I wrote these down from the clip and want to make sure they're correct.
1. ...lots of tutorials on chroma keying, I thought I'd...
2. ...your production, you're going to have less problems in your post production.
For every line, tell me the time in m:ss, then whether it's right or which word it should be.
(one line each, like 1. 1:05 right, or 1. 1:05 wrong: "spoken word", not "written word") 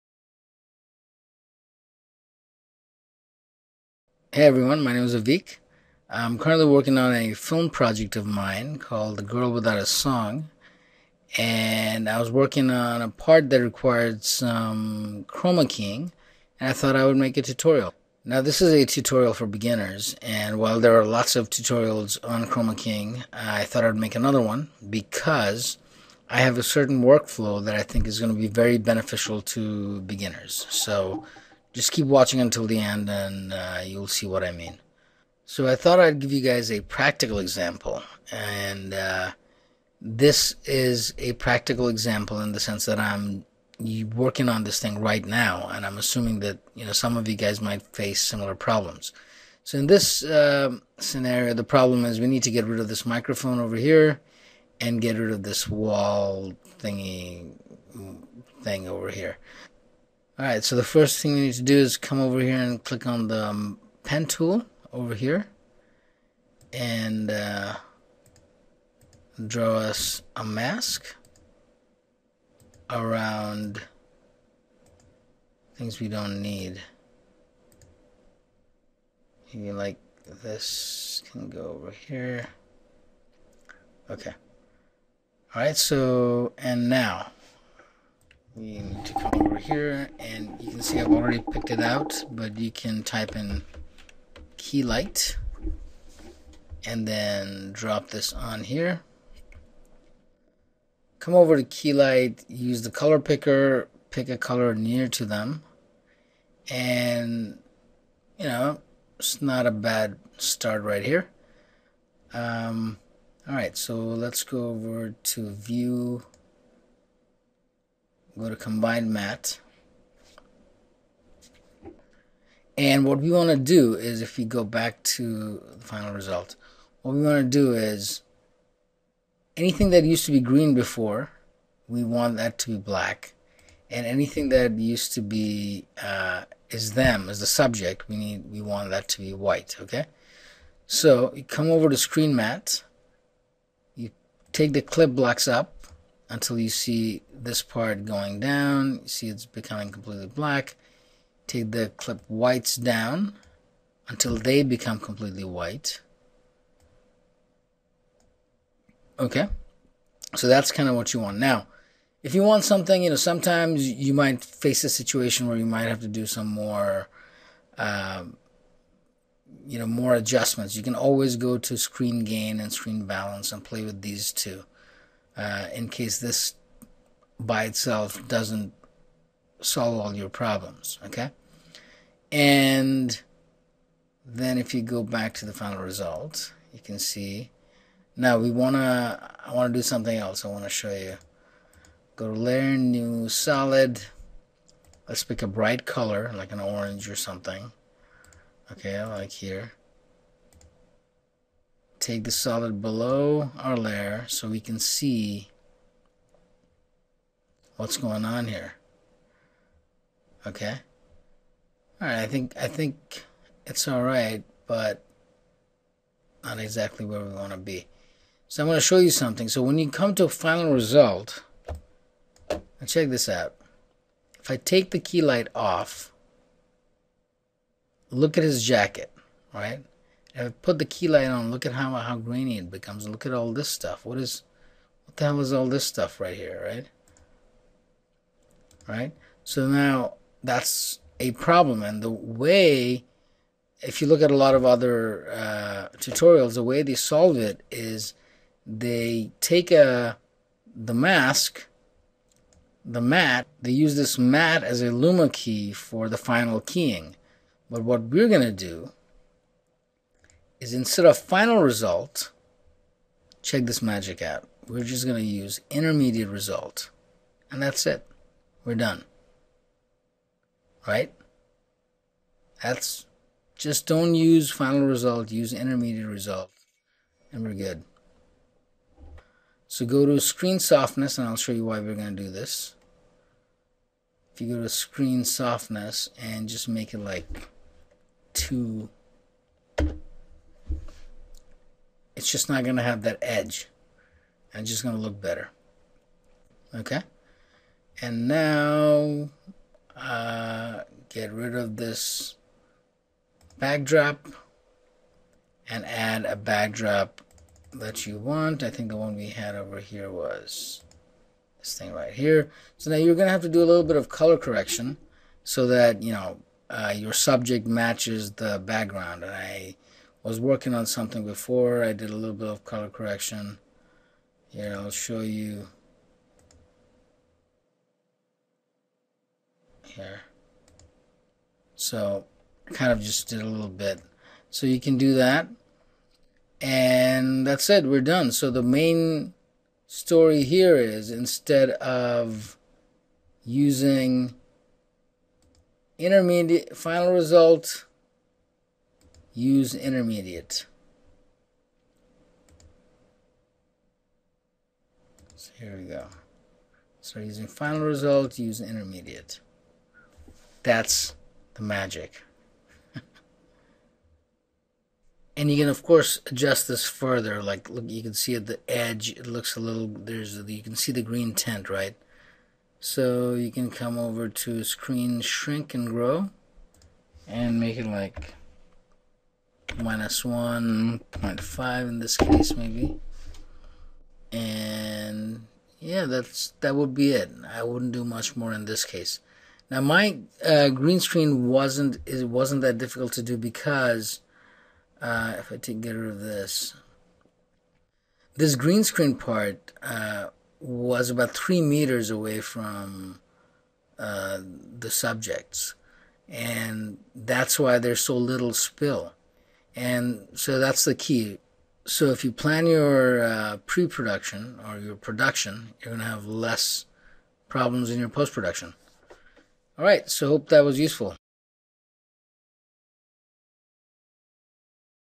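1. 0:21 right
2. 6:54 right.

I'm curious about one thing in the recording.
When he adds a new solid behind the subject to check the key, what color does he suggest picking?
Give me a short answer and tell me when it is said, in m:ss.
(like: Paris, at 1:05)
orange, at 3:16.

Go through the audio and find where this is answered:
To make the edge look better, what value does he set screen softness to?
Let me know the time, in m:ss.
4:48.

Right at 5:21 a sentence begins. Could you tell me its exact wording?
I did a little bit of color correction.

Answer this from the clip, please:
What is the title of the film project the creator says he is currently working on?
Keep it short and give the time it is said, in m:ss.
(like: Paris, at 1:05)
The Girl Without a Song, at 0:09.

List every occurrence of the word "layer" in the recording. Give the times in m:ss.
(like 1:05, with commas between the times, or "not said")
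3:12, 3:23.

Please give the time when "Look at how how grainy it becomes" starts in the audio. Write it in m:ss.
3:51.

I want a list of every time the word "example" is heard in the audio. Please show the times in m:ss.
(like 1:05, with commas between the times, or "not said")
0:37, 0:41.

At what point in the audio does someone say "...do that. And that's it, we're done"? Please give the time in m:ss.
5:34.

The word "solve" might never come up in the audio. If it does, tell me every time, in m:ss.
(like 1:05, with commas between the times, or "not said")
2:59, 4:06.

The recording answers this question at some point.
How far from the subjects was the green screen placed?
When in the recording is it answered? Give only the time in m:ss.
6:41.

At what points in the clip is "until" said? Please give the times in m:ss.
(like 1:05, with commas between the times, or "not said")
0:32, 2:26, 2:34.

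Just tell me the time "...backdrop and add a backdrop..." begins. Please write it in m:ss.
5:03.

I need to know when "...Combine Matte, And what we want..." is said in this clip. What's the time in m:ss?
1:58.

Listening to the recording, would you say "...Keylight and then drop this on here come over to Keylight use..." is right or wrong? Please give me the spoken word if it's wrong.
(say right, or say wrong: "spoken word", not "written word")
right.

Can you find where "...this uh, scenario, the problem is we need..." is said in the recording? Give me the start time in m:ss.
0:49.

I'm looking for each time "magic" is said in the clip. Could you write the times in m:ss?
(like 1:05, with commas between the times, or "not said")
4:23, 6:01.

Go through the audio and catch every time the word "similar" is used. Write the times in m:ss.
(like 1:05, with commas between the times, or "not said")
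0:48.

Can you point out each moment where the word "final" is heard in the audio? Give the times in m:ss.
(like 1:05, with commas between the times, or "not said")
2:05, 3:05, 3:40, 4:16, 4:21, 4:34, 5:46, 5:57.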